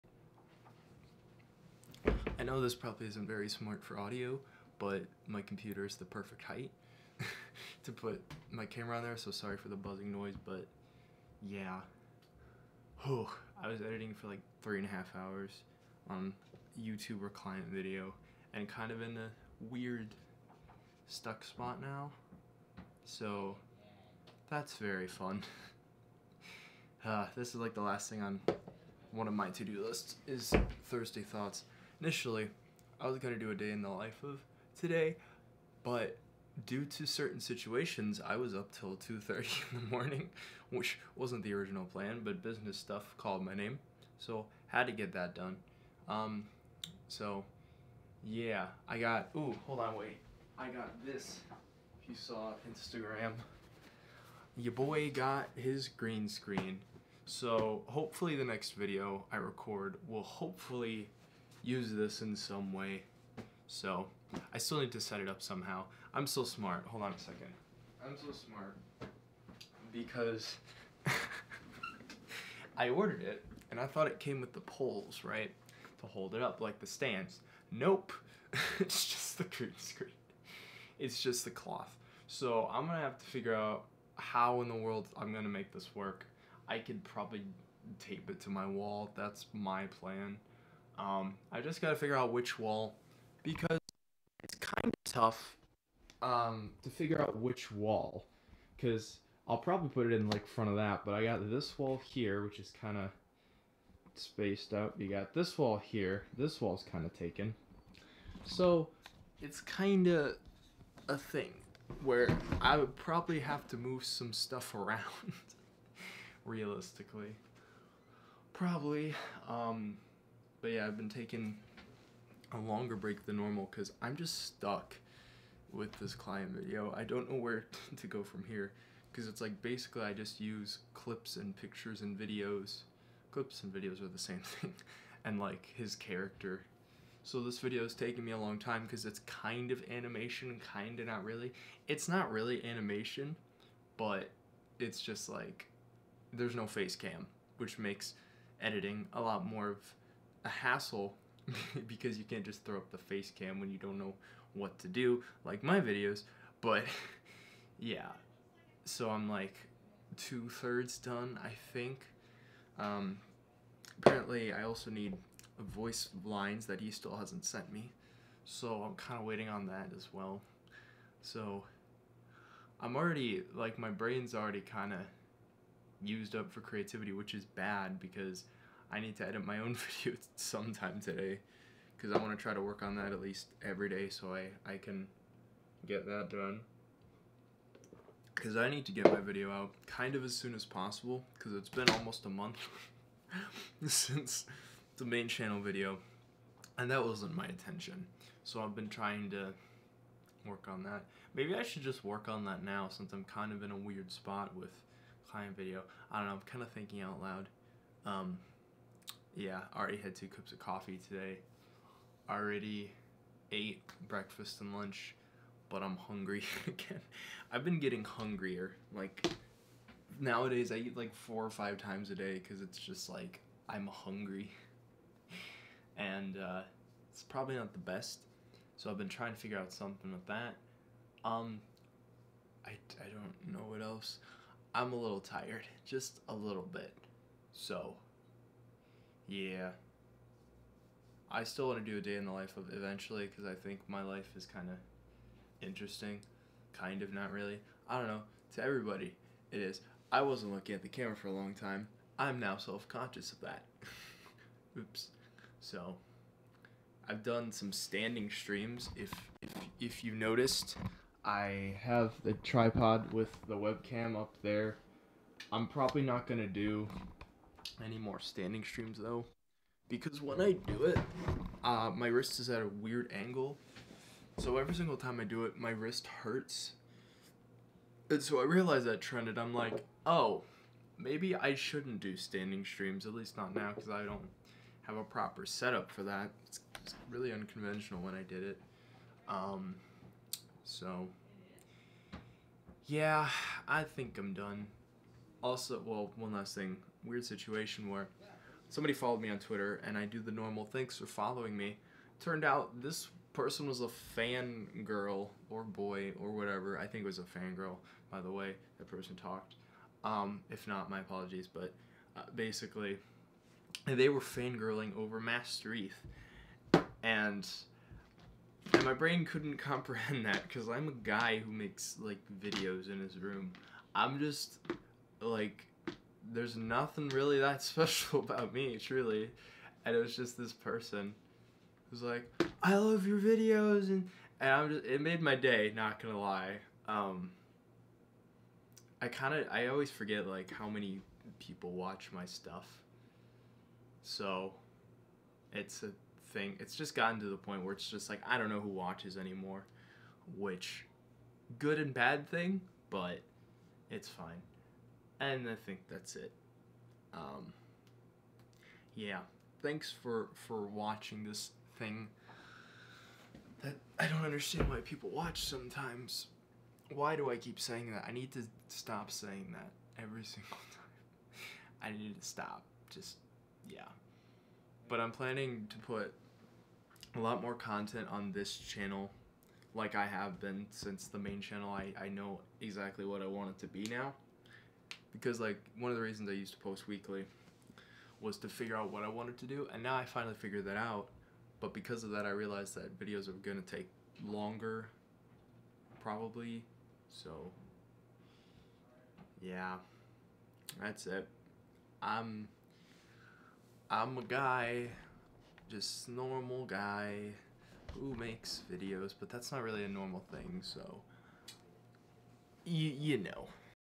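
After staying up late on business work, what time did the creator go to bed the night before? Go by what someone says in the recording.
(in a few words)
2:30.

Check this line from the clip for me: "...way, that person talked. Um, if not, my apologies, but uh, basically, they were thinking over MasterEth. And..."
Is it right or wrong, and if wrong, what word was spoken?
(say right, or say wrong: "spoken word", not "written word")
wrong: "fangirling", not "thinking".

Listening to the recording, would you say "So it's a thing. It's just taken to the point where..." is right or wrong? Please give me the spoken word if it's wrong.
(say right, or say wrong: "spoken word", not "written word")
wrong: "gotten", not "taken".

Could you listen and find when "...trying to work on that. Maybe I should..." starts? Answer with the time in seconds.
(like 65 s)
198 s.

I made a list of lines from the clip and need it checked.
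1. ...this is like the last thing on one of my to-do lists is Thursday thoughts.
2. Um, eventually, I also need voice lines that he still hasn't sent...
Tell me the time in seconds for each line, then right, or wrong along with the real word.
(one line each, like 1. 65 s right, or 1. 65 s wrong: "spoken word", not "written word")
1. 27 s right
2. 162 s wrong: "apparently", not "eventually".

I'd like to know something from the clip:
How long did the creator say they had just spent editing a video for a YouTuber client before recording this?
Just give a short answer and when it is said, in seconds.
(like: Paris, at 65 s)
3.5 hours, at 14 s.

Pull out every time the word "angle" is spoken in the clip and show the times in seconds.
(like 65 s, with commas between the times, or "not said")
273 s.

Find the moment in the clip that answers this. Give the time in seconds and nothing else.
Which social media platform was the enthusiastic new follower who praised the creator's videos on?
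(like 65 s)
299 s.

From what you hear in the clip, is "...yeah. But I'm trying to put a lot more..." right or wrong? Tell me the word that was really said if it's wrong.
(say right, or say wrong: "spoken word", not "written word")
wrong: "planning", not "trying".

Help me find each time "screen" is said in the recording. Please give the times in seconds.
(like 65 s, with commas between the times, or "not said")
56 s, 79 s.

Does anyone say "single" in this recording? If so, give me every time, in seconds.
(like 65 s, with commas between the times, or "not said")
274 s, 370 s.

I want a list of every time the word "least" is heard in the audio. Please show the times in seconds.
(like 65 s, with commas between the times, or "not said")
183 s, 283 s.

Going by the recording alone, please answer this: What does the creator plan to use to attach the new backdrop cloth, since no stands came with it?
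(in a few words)
tape.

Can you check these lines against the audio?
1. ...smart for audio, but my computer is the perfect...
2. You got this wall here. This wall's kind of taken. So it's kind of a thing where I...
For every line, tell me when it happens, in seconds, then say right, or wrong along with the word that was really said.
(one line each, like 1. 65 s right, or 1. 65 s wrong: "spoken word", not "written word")
1. 3 s right
2. 104 s right.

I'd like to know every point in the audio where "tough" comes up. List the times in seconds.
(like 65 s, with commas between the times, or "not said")
95 s.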